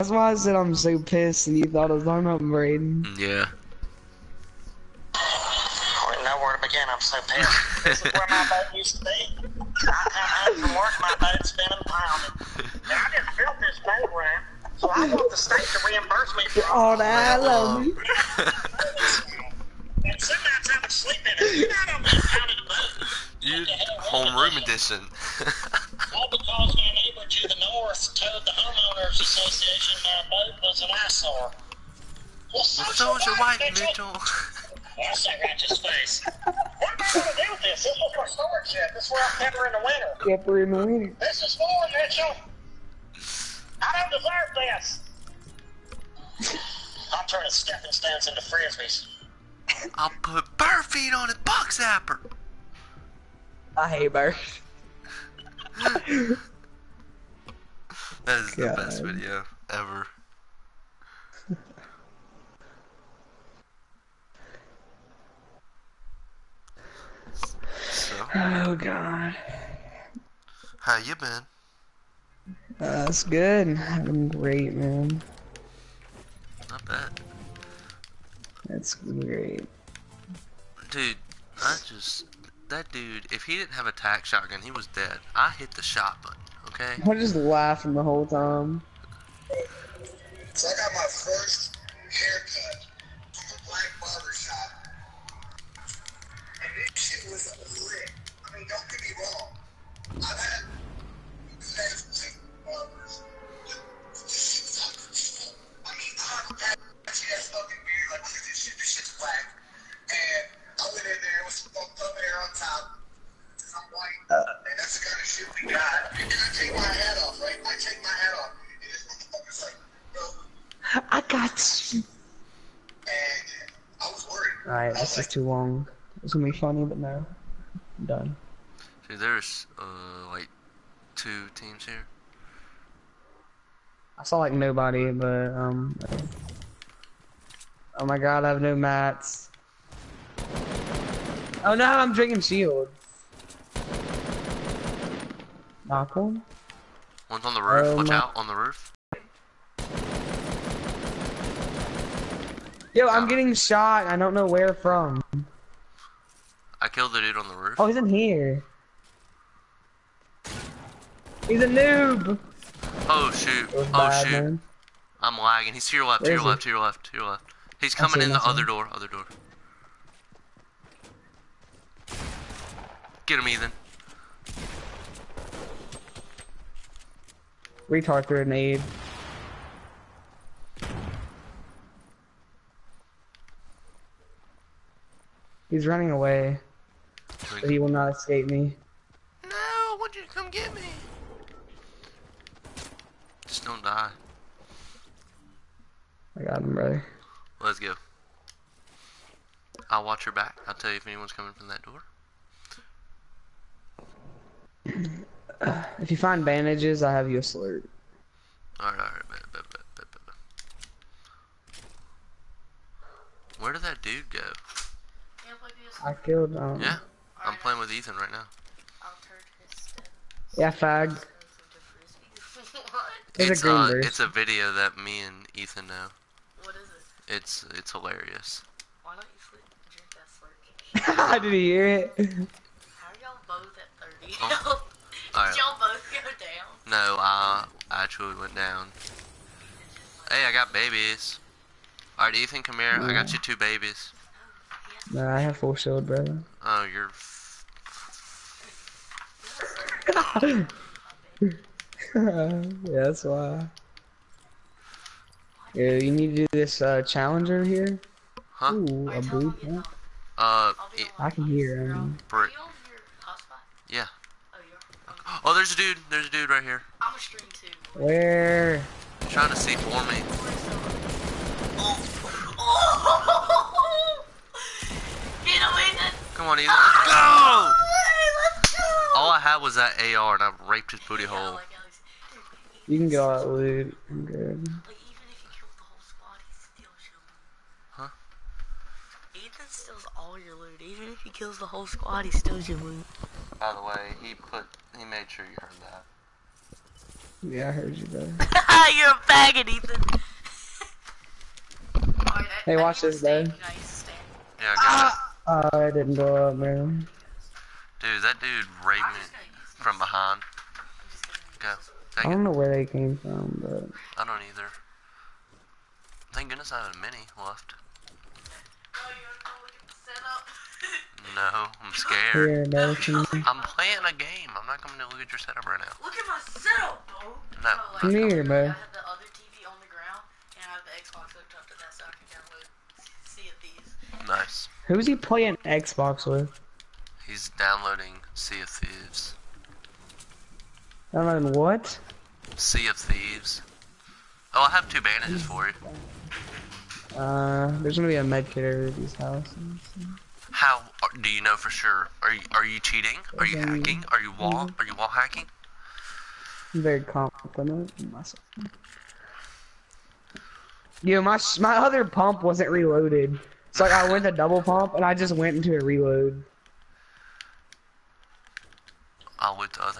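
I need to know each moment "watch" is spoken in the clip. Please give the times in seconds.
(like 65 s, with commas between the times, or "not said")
147 s, 200 s, 302 s.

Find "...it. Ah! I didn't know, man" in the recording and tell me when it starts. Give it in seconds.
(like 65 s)
303 s.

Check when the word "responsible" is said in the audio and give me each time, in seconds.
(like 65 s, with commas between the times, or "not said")
not said.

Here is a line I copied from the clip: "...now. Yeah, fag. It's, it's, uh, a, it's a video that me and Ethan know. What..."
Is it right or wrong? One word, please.
right.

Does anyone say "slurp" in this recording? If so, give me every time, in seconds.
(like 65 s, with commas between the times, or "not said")
207 s, 231 s.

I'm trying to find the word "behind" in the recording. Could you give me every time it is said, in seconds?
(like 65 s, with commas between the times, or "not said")
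309 s.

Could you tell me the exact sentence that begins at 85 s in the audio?
I hit the shot button, okay?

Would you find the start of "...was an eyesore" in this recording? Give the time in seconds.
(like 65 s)
30 s.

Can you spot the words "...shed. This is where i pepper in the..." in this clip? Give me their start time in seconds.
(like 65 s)
38 s.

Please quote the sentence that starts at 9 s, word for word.
I come home from work, my boat's been impounded.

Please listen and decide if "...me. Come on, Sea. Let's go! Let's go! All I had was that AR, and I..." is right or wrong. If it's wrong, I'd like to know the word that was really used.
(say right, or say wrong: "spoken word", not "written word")
wrong: "Ethan", not "Sea".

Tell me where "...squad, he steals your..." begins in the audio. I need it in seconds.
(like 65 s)
291 s.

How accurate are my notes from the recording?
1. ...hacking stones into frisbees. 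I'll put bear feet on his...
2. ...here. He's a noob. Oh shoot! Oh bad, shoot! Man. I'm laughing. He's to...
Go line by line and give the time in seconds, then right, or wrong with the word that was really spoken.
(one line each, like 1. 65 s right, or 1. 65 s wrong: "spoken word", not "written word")
1. 47 s wrong: "stepping", not "hacking"
2. 158 s wrong: "lagging", not "laughing".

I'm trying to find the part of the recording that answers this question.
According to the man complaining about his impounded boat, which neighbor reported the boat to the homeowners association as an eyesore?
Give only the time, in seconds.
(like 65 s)
26 s.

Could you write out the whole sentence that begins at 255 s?
Yeah, you need to do this uh, challenger here.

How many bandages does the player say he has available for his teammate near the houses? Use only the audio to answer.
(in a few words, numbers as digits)
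2.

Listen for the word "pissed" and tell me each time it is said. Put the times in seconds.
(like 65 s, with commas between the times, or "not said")
0 s, 7 s.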